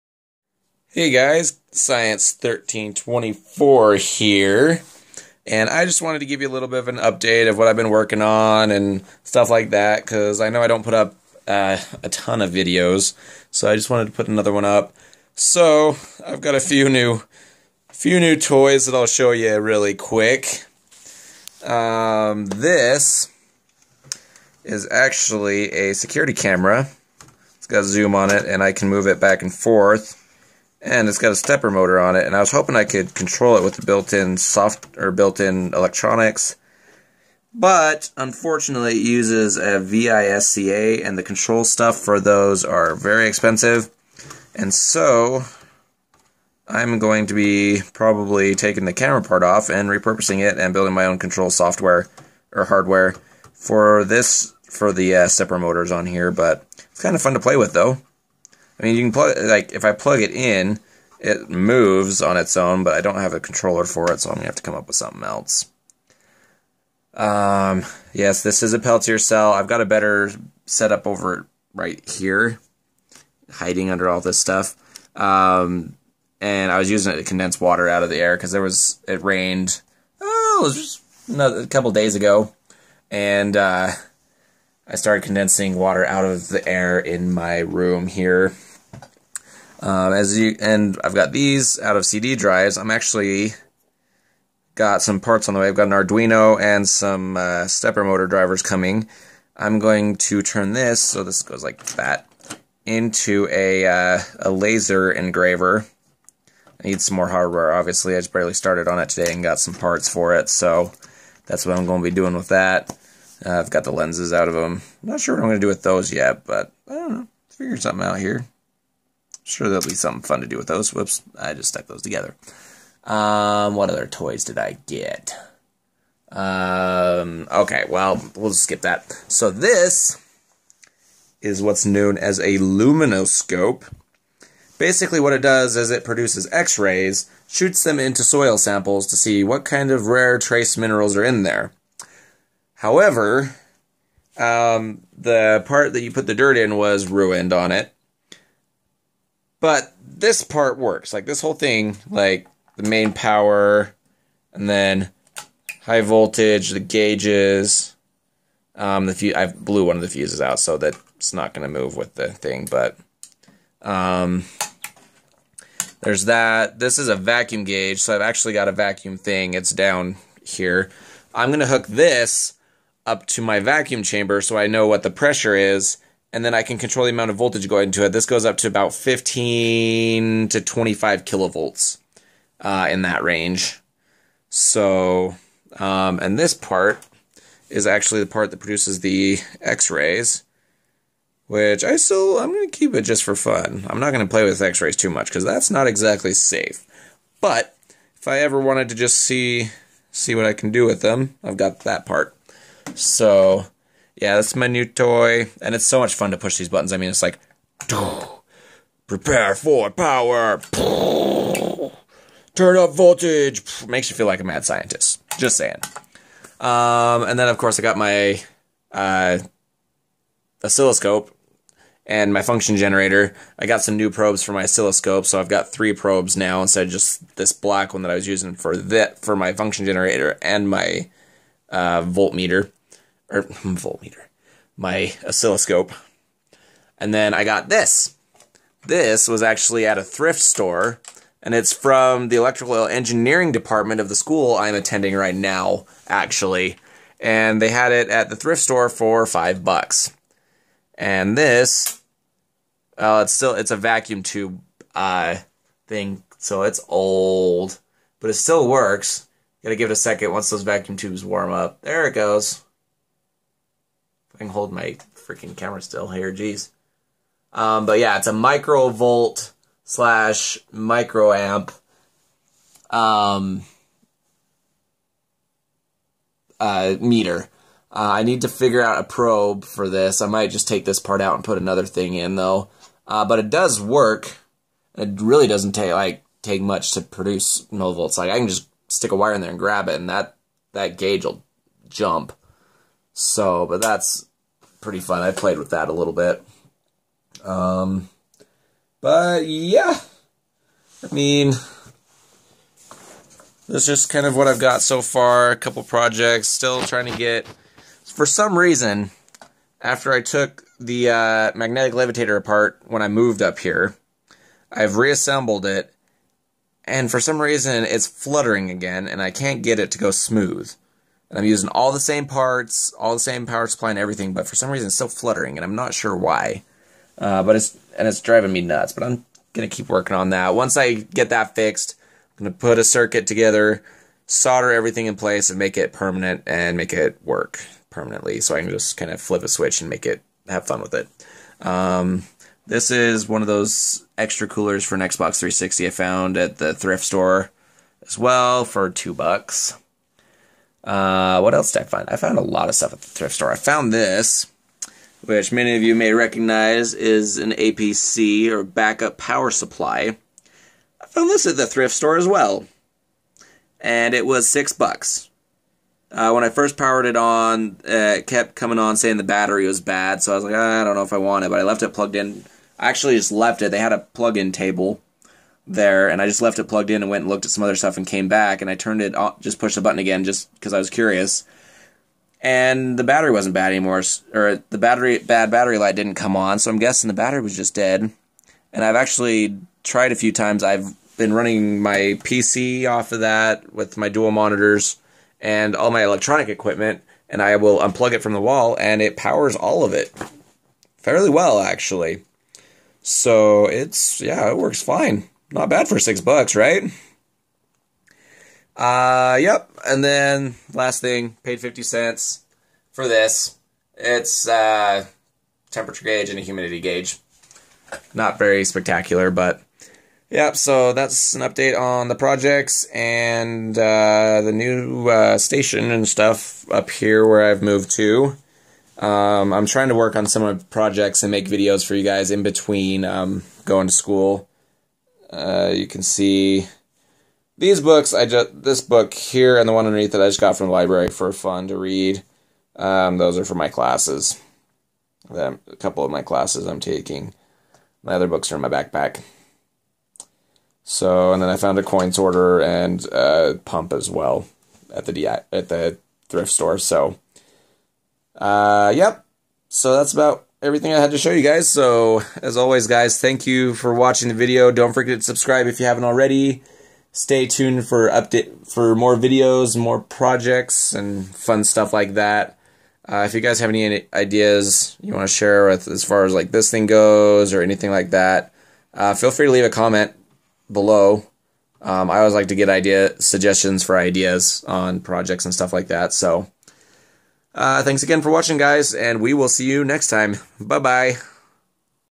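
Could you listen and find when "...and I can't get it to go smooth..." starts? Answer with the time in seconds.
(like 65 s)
319 s.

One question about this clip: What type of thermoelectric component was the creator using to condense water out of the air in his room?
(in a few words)
Peltier cell.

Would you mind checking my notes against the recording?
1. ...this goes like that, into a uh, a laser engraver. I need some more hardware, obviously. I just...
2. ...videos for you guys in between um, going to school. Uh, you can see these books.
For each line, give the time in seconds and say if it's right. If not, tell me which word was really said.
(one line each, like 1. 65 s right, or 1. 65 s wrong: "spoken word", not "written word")
1. 101 s right
2. 431 s right.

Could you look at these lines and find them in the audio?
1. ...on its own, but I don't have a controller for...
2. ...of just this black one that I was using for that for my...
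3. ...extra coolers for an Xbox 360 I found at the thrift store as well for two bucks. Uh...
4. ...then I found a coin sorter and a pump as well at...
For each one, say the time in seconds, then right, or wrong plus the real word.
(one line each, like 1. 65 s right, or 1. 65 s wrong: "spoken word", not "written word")
1. 62 s right
2. 226 s right
3. 344 s right
4. 451 s right.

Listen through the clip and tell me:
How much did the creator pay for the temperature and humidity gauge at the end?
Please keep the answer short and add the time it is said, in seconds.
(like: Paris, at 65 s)
50 cents, at 411 s.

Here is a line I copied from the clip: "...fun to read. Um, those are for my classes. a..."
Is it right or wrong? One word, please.
right.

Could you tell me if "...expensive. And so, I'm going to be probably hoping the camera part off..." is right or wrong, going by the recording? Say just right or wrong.
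wrong.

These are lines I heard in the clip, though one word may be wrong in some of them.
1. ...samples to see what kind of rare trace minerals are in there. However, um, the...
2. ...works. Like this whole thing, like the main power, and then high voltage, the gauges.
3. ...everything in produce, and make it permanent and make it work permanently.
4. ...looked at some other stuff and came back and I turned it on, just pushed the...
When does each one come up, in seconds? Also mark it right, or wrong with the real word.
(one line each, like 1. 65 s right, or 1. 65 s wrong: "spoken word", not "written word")
1. 138 s right
2. 150 s right
3. 334 s wrong: "place", not "produce"
4. 377 s right.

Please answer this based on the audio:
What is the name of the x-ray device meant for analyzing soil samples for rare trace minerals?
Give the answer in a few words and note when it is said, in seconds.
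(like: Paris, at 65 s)
luminoscope, at 132 s.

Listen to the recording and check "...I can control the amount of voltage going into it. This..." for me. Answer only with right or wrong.
right.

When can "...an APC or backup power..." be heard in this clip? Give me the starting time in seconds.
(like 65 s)
357 s.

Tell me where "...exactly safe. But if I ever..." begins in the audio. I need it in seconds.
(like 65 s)
195 s.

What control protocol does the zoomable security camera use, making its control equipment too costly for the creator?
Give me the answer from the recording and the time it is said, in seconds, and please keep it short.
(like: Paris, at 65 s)
VISCA, at 39 s.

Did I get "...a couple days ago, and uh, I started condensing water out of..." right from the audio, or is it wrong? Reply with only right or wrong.
right.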